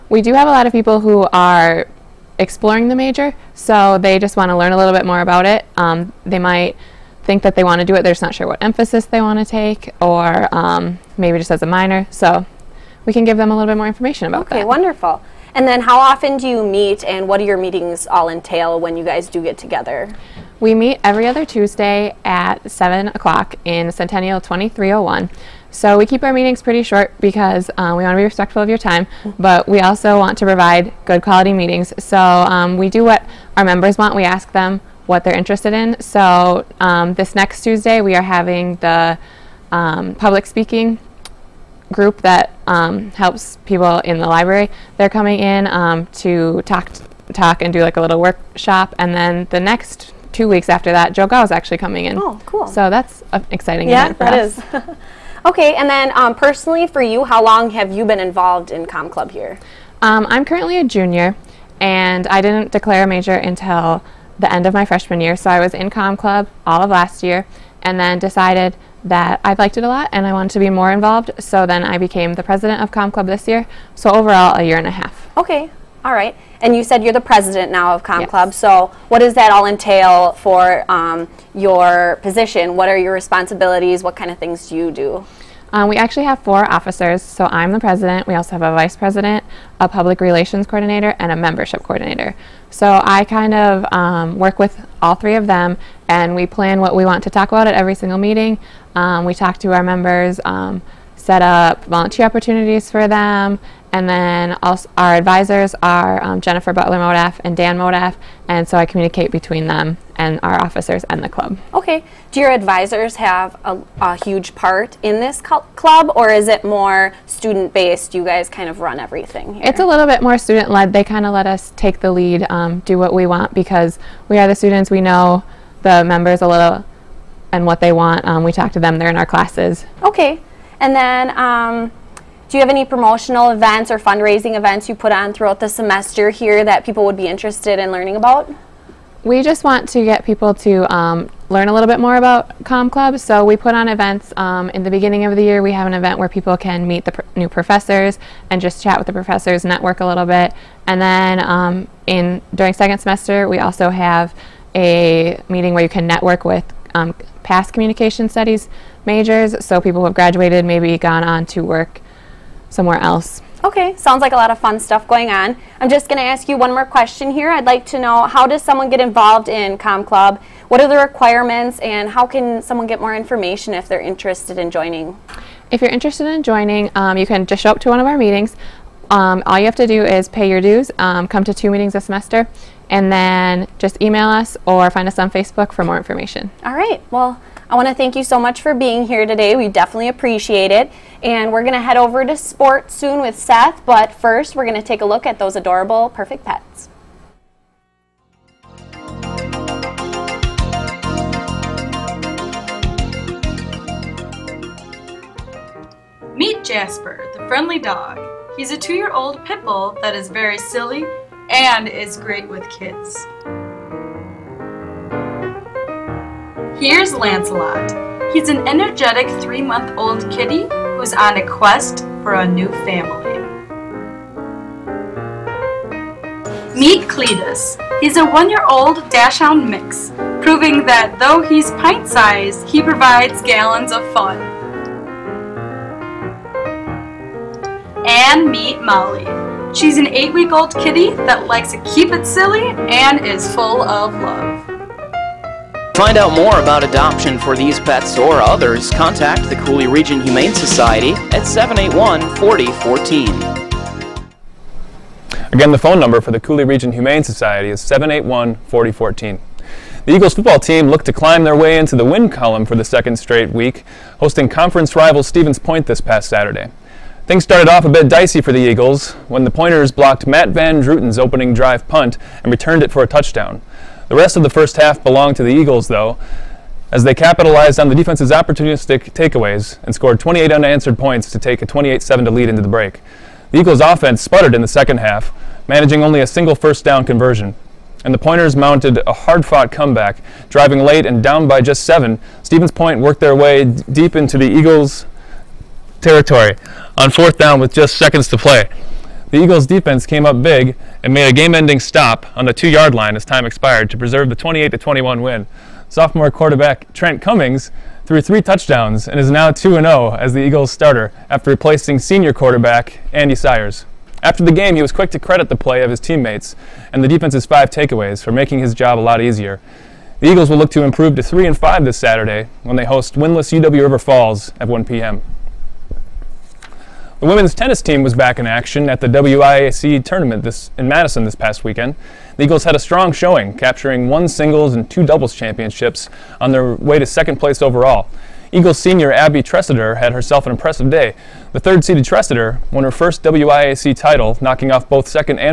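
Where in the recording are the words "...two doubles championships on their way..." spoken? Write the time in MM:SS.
05:34.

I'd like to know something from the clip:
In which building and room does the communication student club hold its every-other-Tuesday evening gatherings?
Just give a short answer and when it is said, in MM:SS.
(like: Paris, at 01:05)
Centennial 2301, at 00:23.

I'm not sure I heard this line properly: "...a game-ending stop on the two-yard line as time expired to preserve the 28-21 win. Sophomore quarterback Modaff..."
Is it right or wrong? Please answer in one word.
wrong.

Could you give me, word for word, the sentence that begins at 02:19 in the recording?
we just want to get people to um, learn a little bit more about Com Club.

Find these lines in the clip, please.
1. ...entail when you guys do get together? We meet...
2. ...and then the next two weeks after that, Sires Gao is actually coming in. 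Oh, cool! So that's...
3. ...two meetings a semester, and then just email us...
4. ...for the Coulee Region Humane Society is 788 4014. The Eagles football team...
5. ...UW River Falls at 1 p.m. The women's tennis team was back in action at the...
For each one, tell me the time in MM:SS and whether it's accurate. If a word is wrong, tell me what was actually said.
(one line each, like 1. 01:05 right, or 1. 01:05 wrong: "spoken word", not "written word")
1. 00:18 right
2. 00:48 wrong: "Joe", not "Sires"
3. 03:01 right
4. 04:16 wrong: "781", not "788"
5. 05:23 right.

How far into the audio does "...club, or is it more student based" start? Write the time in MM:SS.
01:55.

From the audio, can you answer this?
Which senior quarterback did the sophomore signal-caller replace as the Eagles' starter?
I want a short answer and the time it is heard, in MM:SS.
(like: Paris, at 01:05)
Andy Sires, at 05:13.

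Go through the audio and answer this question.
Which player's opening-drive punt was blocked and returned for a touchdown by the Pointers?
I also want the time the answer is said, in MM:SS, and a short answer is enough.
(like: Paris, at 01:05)
Matt Van Druten, at 04:30.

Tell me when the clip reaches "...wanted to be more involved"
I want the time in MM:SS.
01:10.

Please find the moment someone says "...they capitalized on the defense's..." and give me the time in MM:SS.
04:37.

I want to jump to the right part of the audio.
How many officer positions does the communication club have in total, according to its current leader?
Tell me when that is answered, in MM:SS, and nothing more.
01:26.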